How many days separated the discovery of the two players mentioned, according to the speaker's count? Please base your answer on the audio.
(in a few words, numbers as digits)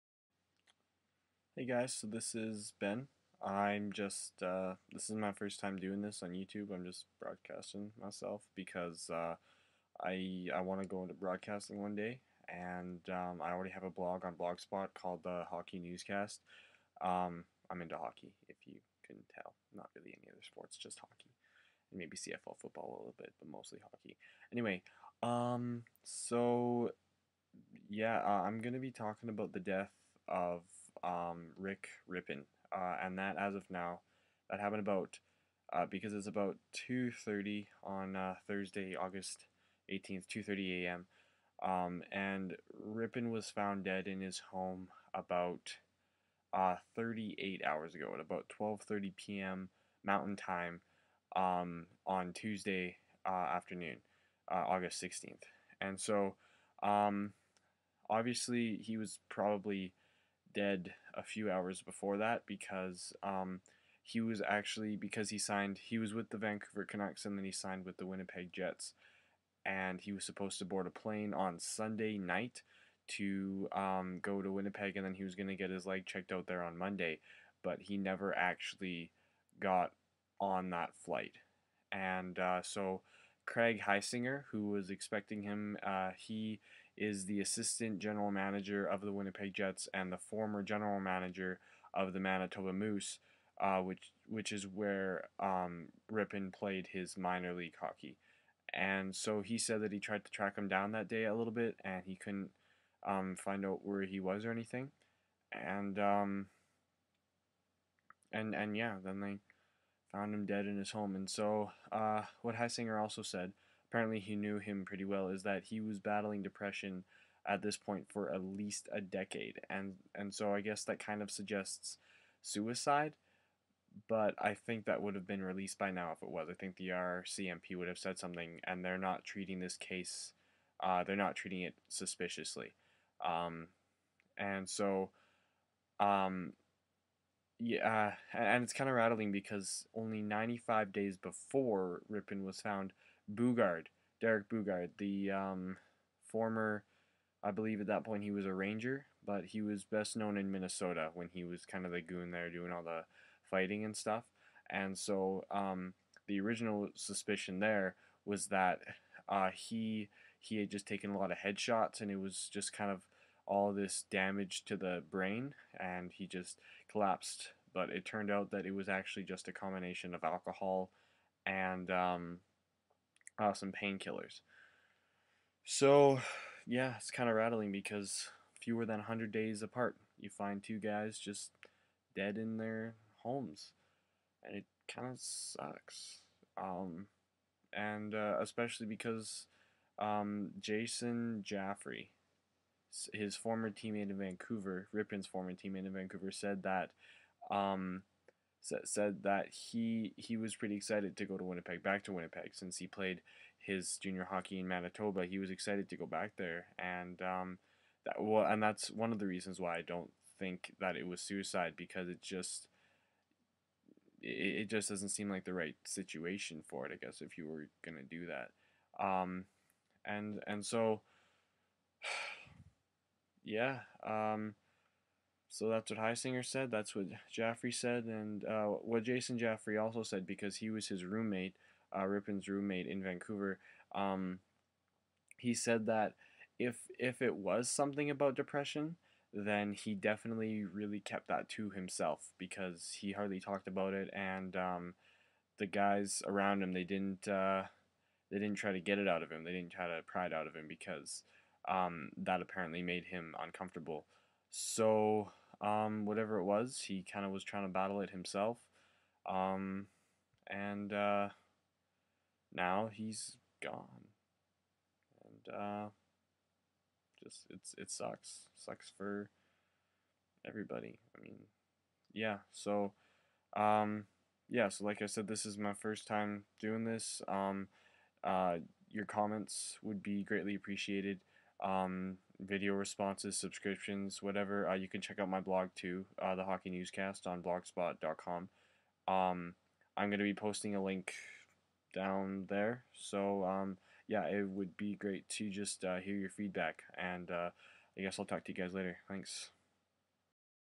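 95.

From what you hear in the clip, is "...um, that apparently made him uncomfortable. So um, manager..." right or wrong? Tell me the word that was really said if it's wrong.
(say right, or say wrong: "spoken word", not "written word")
wrong: "whatever", not "manager".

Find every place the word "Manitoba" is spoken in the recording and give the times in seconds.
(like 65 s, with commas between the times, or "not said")
92 s, 204 s.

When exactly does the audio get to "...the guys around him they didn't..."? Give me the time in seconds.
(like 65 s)
245 s.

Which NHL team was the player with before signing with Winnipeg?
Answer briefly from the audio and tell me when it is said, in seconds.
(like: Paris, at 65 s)
Vancouver Canucks, at 66 s.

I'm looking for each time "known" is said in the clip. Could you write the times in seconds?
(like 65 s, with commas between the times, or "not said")
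150 s.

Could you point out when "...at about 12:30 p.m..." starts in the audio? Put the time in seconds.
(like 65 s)
48 s.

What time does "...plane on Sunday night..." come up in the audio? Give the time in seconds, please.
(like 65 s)
70 s.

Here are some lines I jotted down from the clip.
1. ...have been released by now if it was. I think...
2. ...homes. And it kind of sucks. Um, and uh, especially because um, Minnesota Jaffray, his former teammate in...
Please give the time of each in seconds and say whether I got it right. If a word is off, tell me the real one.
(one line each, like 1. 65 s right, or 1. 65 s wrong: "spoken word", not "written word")
1. 125 s right
2. 183 s wrong: "Jason", not "Minnesota".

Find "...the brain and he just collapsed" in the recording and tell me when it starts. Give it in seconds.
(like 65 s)
164 s.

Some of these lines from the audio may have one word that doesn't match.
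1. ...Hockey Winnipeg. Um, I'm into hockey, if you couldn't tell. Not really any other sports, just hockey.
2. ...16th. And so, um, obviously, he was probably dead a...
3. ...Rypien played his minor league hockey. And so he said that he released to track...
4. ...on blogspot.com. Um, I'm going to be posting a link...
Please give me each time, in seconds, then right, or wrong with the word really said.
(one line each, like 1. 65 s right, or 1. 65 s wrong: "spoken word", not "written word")
1. 15 s wrong: "Newscast", not "Winnipeg"
2. 55 s right
3. 96 s wrong: "tried", not "released"
4. 287 s right.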